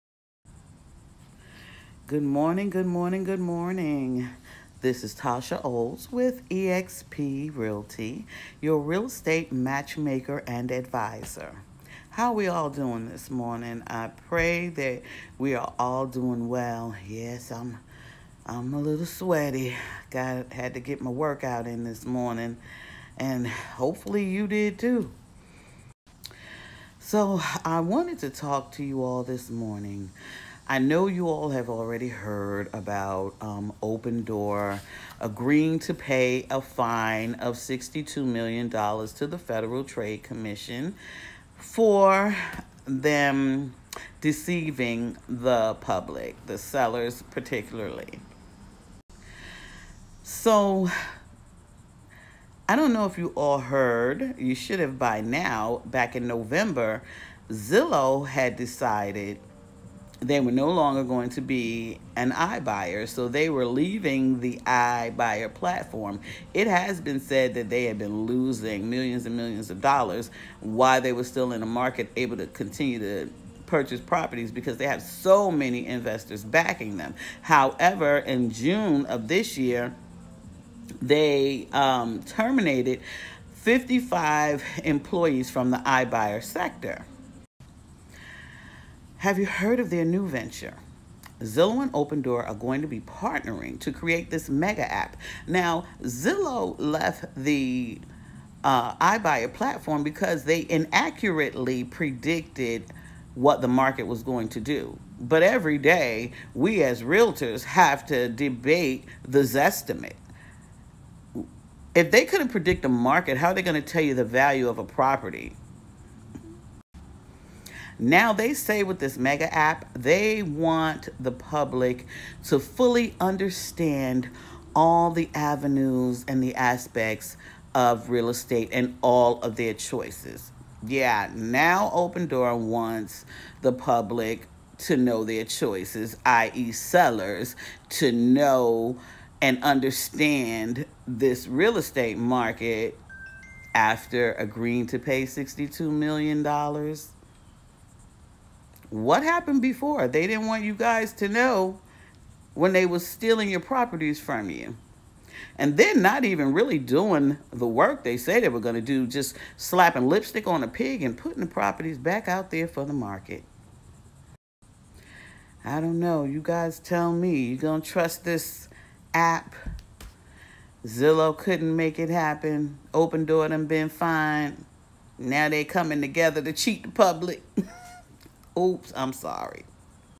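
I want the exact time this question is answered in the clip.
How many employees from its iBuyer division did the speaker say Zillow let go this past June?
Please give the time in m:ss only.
1:23.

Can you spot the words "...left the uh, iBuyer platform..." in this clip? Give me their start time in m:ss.
1:36.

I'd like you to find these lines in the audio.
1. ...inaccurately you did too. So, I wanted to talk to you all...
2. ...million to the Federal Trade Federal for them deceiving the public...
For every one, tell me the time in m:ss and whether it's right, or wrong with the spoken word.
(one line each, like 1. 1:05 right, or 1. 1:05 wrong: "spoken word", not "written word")
1. 0:23 wrong: "hopefully", not "inaccurately"
2. 0:38 wrong: "Commission", not "Federal".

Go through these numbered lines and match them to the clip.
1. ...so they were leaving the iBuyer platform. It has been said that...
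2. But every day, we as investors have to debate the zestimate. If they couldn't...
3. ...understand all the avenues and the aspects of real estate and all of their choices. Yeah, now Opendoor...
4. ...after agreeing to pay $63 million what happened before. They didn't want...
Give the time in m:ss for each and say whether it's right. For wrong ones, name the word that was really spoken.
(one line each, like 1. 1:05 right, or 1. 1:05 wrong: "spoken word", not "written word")
1. 1:03 right
2. 1:45 wrong: "realtors", not "investors"
3. 2:03 right
4. 2:23 wrong: "62", not "63".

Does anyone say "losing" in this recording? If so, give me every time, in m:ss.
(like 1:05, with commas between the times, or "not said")
1:08.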